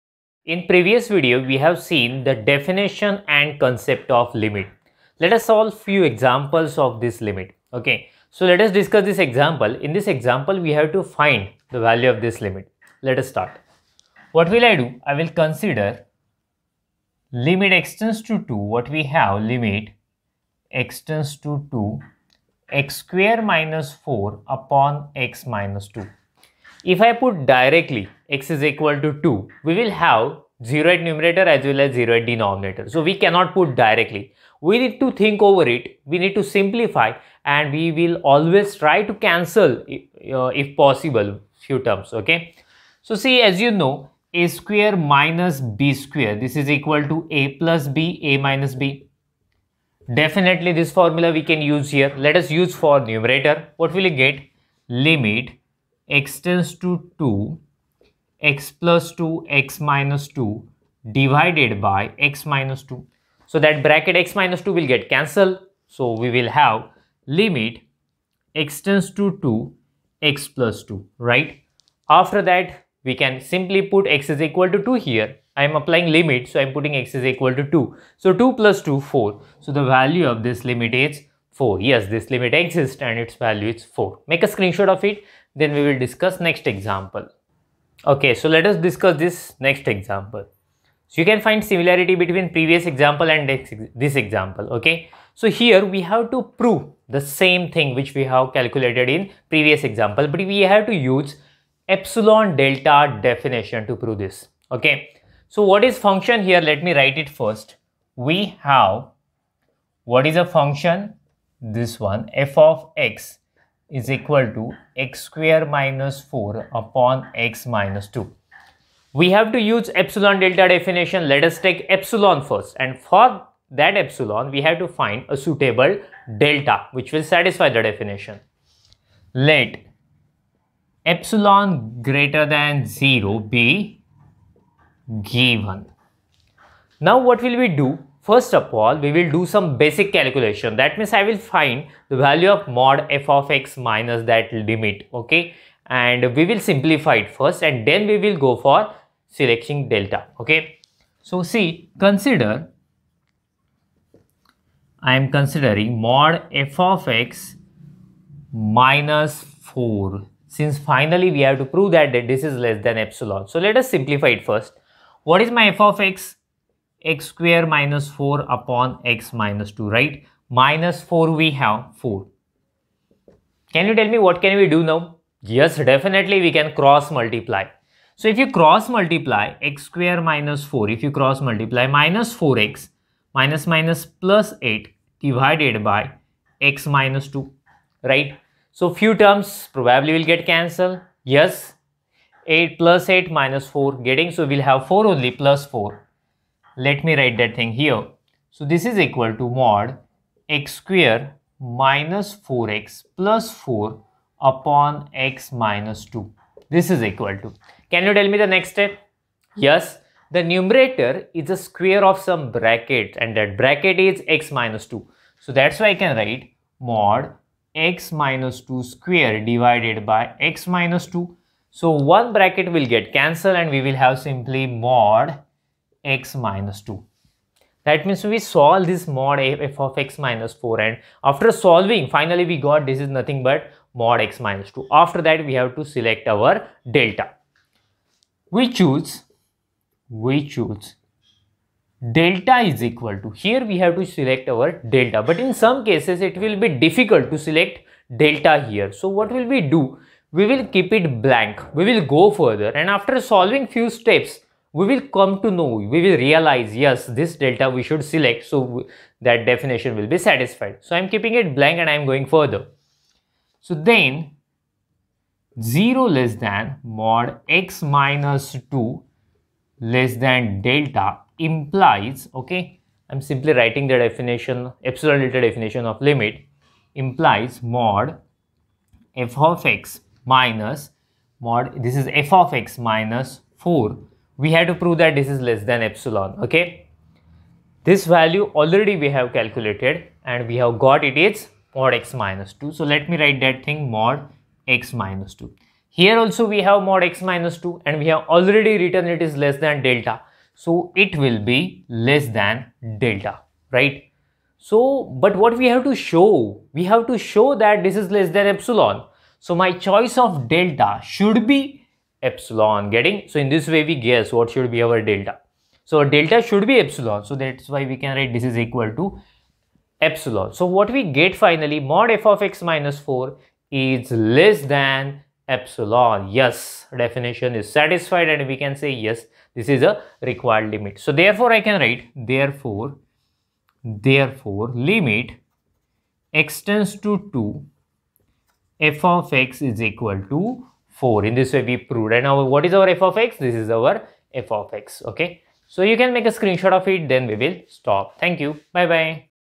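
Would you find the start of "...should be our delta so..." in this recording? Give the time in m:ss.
5:14.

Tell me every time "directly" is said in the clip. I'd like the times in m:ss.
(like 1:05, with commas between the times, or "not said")
0:27, 0:33.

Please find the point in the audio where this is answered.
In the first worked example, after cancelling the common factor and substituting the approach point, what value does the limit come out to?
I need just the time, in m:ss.
1:19.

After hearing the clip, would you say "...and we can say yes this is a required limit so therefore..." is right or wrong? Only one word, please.
right.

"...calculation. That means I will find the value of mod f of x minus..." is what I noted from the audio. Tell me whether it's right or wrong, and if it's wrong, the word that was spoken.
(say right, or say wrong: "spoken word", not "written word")
right.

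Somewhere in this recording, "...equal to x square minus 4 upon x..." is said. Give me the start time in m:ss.
1:54.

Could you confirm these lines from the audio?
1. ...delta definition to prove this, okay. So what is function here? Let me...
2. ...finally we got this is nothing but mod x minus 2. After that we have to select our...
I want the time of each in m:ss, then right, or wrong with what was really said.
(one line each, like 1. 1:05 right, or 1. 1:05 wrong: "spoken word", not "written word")
1. 1:42 right
2. 3:52 right.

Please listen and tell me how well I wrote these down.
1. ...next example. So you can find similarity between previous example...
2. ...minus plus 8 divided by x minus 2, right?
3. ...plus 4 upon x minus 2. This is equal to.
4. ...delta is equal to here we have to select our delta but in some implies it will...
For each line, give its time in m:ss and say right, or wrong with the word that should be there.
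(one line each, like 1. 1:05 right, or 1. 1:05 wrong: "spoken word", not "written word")
1. 1:29 right
2. 3:03 right
3. 3:23 right
4. 4:02 wrong: "cases", not "implies".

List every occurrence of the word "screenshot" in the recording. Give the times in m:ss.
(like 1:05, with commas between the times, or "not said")
1:24, 5:46.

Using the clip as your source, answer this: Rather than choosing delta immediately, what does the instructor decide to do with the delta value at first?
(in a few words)
keep it blank.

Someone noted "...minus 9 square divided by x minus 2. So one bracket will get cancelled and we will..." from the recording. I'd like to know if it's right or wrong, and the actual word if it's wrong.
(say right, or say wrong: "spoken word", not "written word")
wrong: "2", not "9".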